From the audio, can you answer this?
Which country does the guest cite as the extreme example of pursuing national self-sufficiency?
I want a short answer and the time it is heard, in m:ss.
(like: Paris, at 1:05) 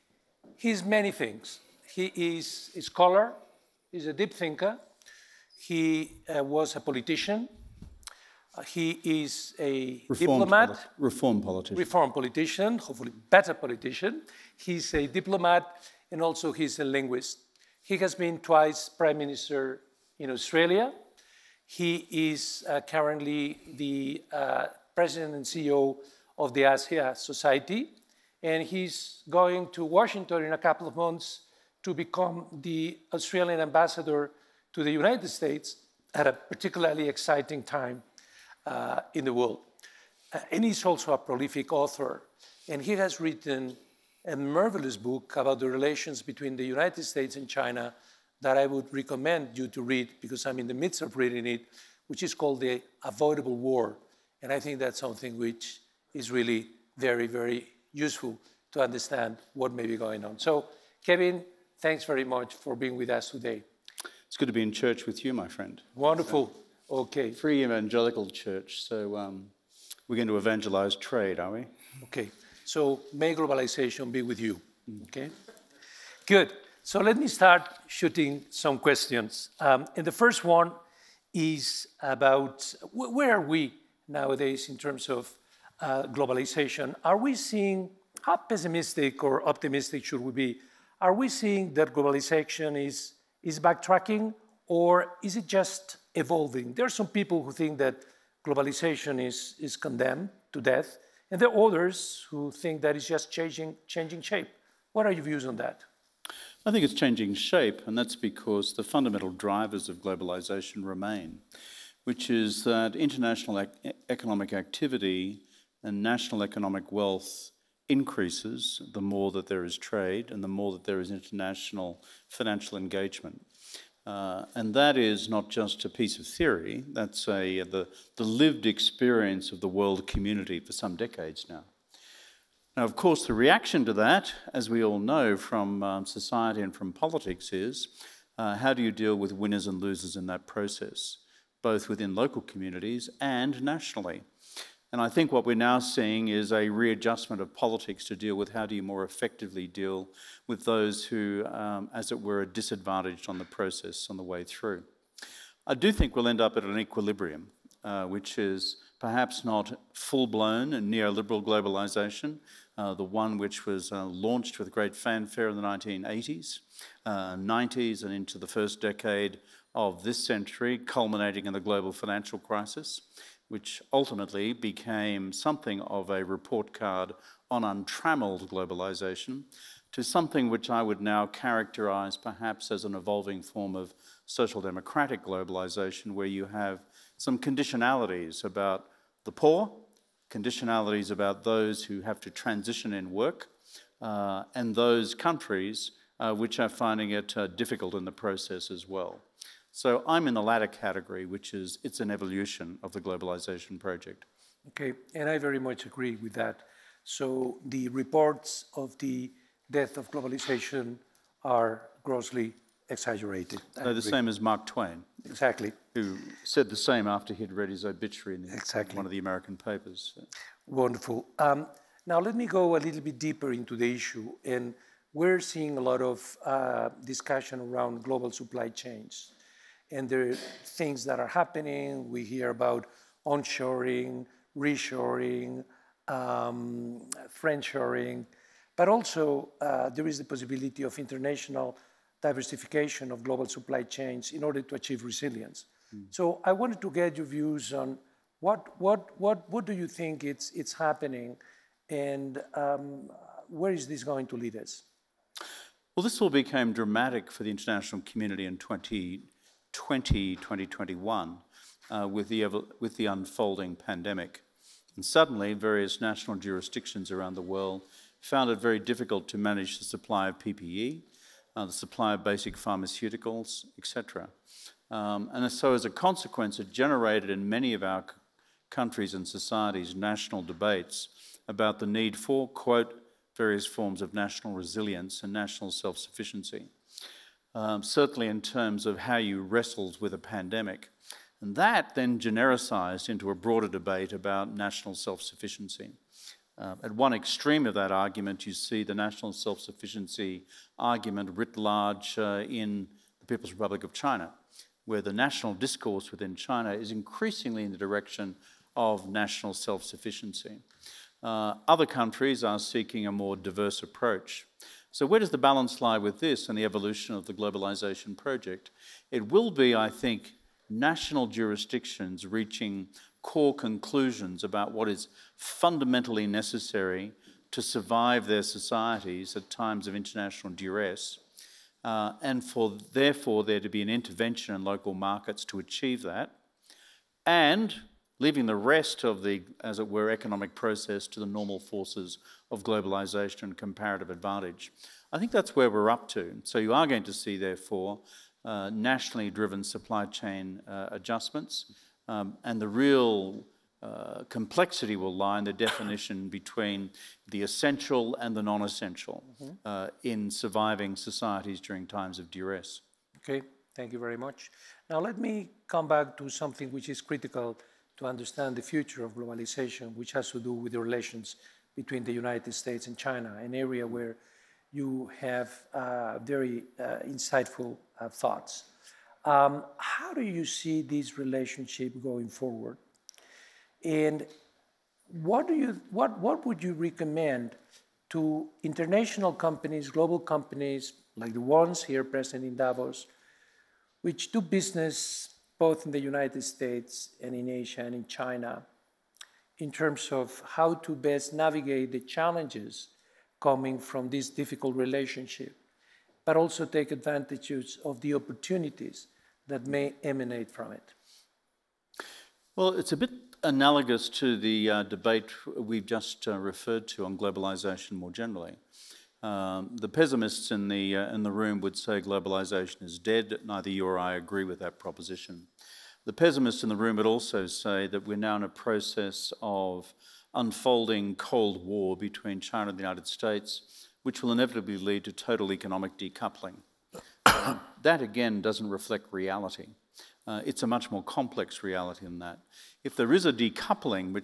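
People's Republic of China, at 5:03.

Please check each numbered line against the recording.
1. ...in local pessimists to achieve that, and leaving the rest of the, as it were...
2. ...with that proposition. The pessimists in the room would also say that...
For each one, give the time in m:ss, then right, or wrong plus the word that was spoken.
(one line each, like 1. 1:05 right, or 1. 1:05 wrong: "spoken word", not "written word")
1. 5:34 wrong: "markets", not "pessimists"
2. 7:04 right.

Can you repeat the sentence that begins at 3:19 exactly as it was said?
So I'm in the latter category, which is it's an evolution of the globalization project.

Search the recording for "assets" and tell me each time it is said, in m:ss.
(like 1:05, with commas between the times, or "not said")
not said.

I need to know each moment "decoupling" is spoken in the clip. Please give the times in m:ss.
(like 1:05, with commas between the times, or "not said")
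7:15, 7:23.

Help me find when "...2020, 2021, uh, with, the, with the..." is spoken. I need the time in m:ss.
4:18.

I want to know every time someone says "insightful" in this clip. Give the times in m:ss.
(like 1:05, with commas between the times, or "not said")
6:17.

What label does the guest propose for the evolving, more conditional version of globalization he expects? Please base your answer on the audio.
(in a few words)
social democratic globalization.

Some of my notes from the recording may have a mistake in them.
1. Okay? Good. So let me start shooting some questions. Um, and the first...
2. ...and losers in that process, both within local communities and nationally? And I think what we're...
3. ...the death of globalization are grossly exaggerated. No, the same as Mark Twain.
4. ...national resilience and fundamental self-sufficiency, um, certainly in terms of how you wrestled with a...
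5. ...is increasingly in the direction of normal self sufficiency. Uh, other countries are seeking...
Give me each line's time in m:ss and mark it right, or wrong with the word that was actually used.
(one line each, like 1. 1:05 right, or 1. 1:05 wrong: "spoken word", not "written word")
1. 1:15 right
2. 2:19 right
3. 3:28 right
4. 4:44 wrong: "national", not "fundamental"
5. 5:06 wrong: "national", not "normal".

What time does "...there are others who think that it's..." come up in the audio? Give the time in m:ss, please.
1:41.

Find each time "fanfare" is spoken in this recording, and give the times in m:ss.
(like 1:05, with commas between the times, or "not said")
2:44.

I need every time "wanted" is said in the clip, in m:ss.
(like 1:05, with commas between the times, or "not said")
4:06.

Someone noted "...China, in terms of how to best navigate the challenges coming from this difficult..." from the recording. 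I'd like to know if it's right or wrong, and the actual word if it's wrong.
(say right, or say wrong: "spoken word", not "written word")
right.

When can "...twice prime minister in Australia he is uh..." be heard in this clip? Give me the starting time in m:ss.
0:18.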